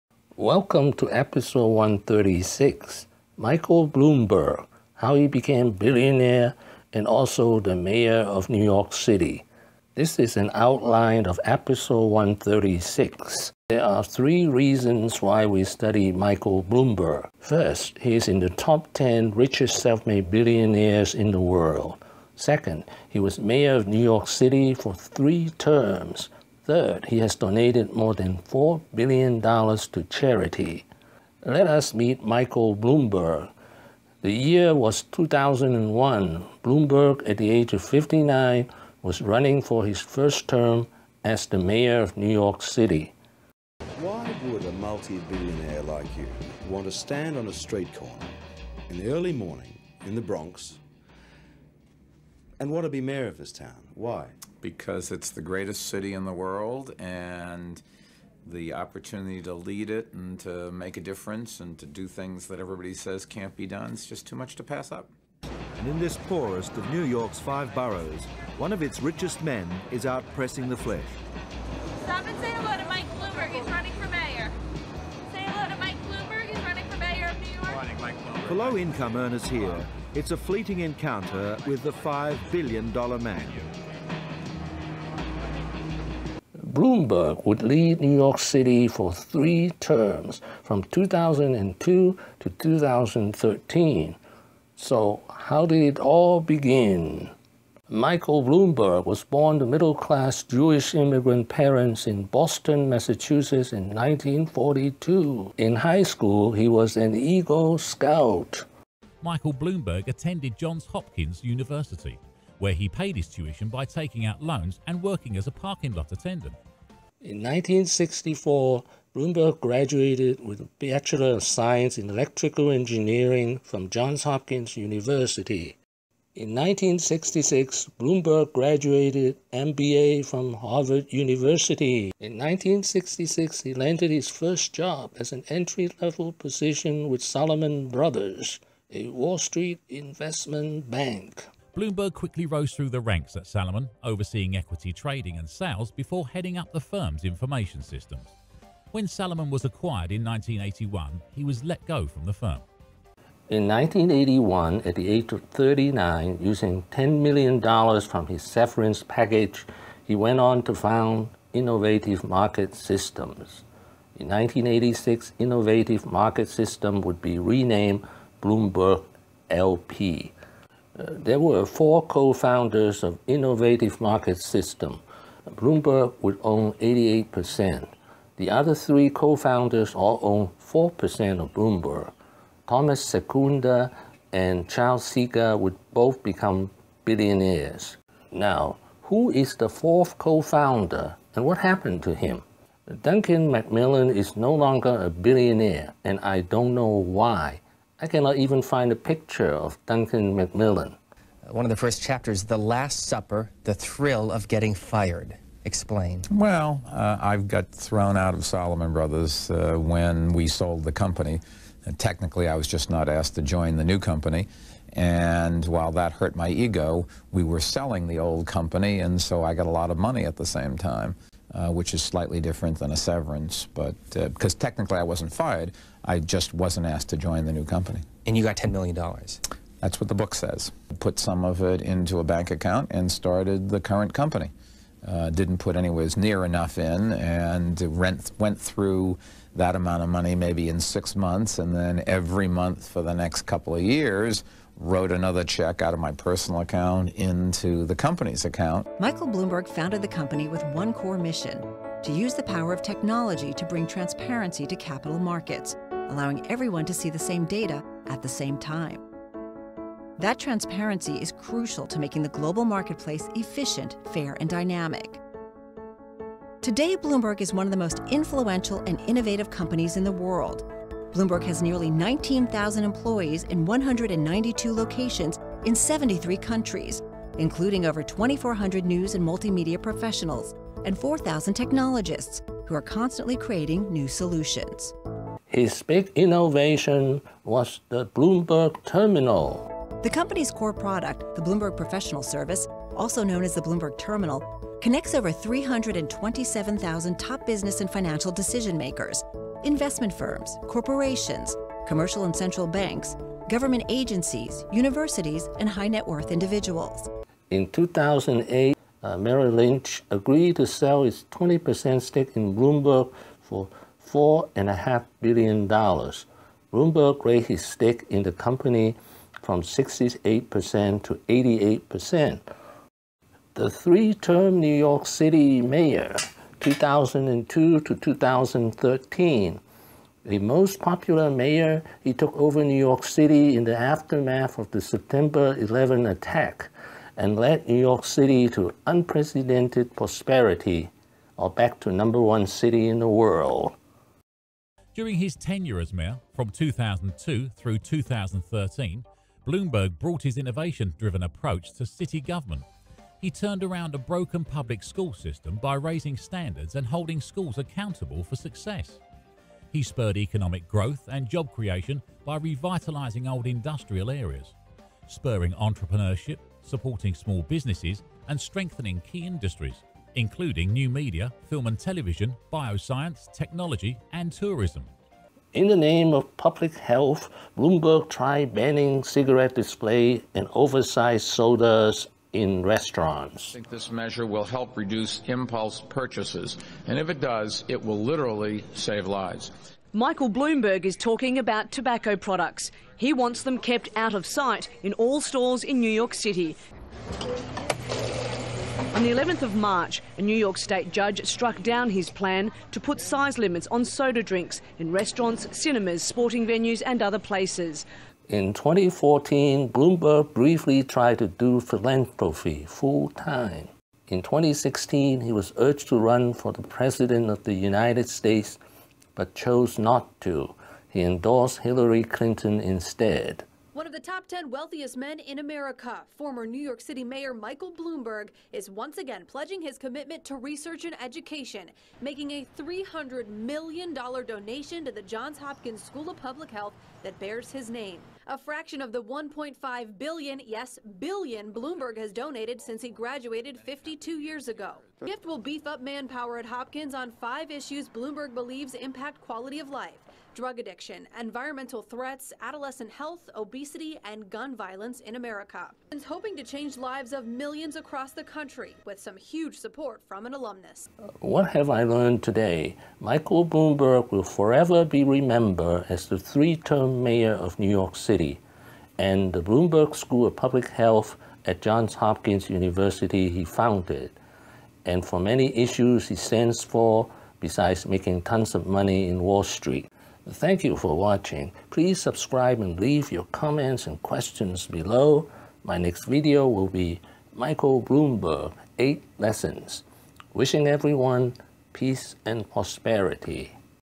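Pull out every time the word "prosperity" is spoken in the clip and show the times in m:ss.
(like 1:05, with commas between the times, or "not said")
5:39, 8:12.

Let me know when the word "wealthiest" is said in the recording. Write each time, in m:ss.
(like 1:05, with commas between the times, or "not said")
7:04.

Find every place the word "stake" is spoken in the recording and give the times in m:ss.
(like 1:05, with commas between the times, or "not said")
5:12, 5:17.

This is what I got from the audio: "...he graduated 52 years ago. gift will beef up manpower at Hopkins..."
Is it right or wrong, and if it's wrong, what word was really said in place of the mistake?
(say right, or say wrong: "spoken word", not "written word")
right.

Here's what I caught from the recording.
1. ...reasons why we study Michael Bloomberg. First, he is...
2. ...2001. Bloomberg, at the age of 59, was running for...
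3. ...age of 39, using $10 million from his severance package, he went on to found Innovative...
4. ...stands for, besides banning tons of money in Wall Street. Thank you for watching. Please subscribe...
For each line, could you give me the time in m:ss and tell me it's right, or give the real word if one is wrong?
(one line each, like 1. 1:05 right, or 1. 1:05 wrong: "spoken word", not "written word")
1. 0:14 right
2. 0:35 right
3. 2:35 right
4. 7:56 wrong: "making", not "banning".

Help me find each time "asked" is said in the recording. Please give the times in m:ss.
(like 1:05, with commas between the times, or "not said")
3:33, 3:46.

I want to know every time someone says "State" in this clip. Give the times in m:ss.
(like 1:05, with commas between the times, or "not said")
6:40, 6:58.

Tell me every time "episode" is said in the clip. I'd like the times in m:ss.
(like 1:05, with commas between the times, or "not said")
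0:01, 0:11.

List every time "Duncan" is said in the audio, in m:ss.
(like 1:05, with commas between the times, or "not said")
3:13, 3:19.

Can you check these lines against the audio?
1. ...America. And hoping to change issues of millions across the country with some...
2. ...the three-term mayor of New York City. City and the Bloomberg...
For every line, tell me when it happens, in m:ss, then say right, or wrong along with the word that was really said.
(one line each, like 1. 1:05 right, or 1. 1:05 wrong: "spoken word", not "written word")
1. 7:35 wrong: "lives", not "issues"
2. 7:46 right.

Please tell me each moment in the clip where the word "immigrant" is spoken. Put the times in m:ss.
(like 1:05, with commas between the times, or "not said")
1:40.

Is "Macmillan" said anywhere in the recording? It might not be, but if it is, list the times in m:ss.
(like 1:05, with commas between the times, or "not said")
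3:13, 3:20.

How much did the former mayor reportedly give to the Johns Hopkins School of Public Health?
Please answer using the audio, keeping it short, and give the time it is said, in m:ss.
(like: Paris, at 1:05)
$300 million, at 7:12.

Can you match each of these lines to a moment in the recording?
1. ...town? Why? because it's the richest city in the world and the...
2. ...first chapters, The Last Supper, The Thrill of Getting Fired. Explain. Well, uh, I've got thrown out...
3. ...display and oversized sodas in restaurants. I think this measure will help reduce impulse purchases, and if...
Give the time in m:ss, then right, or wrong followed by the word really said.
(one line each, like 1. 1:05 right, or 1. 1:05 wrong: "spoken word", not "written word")
1. 0:53 wrong: "greatest", not "richest"
2. 3:21 right
3. 6:19 right.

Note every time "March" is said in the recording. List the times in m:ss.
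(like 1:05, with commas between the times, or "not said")
6:39.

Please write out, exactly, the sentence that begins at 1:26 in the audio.
Bloomberg would lead New York City for three terms from 2002 to 2013.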